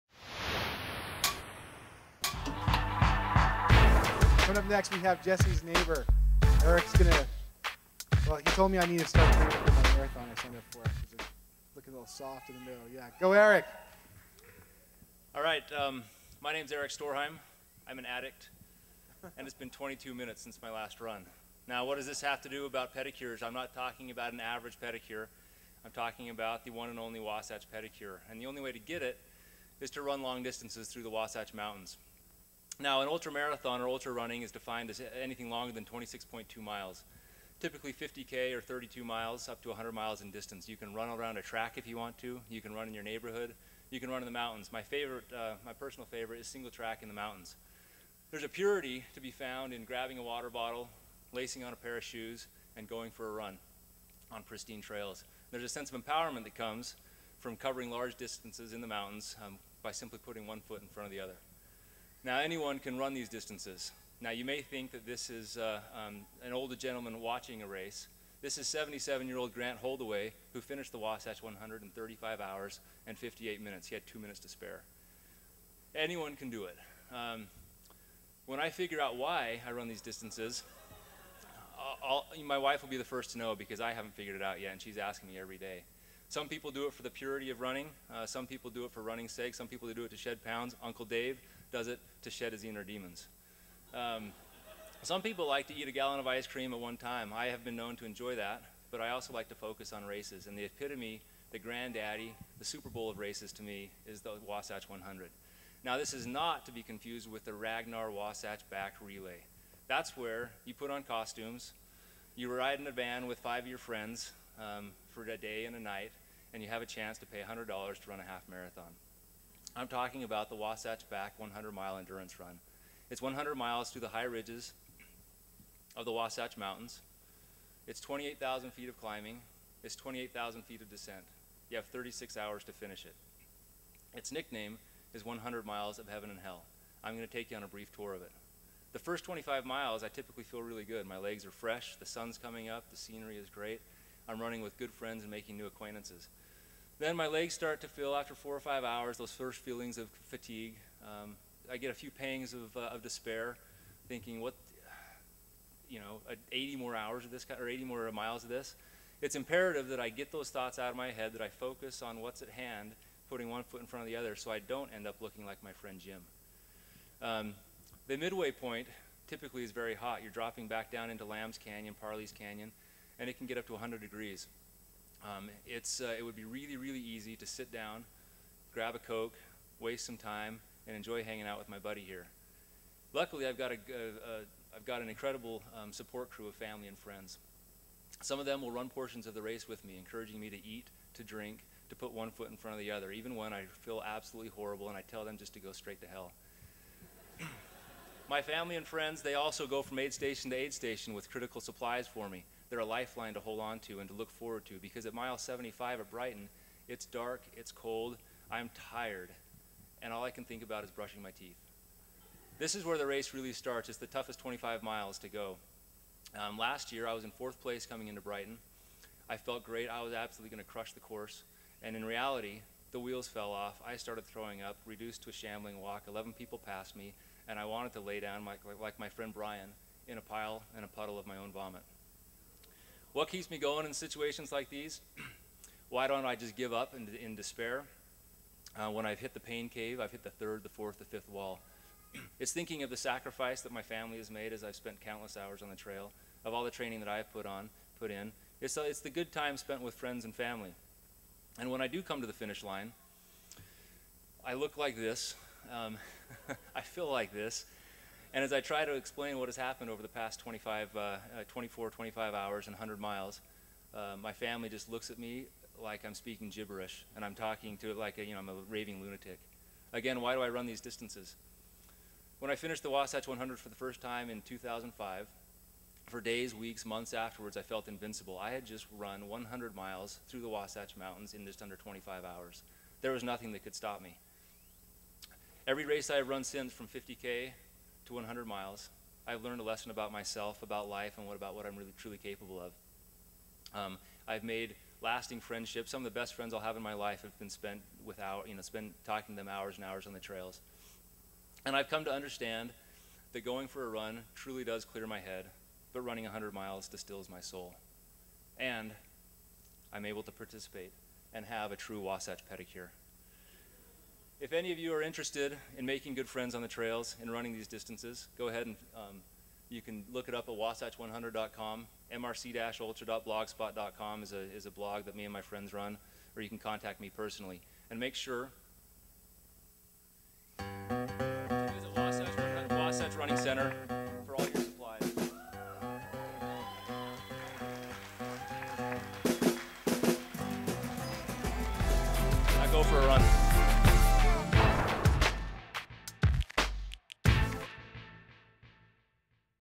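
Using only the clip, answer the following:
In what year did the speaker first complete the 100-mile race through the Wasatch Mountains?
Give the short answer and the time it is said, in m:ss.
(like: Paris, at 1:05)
2005, at 4:34.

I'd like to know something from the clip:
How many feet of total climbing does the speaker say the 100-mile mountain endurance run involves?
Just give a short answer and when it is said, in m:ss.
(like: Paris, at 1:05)
28,000, at 2:08.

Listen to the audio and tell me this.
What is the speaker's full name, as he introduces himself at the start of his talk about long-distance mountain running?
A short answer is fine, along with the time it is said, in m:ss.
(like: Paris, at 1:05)
Erik Storheim, at 0:16.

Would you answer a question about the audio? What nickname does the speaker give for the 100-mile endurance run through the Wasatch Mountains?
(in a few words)
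100 miles of heaven and hell.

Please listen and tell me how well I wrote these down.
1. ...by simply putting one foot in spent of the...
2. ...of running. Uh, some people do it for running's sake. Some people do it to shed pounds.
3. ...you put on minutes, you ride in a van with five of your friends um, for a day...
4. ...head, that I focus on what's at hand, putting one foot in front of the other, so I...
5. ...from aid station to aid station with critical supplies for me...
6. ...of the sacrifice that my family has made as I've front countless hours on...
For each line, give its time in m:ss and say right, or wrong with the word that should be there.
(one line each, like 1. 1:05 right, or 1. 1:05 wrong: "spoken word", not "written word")
1. 0:59 wrong: "front", not "spent"
2. 1:27 right
3. 1:50 wrong: "costumes", not "minutes"
4. 2:41 right
5. 3:19 right
6. 4:02 wrong: "spent", not "front".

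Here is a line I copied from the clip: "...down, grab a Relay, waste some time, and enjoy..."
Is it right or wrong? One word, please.
wrong.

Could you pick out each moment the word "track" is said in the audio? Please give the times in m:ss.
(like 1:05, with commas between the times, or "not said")
0:41, 0:46.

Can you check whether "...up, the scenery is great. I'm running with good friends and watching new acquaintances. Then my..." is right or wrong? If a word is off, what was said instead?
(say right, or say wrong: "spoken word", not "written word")
wrong: "making", not "watching".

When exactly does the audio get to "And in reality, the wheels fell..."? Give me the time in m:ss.
3:41.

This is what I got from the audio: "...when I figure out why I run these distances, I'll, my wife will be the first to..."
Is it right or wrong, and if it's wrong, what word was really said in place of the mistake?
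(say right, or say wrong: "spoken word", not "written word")
right.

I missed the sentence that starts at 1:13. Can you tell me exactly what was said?
He had two minutes to spare.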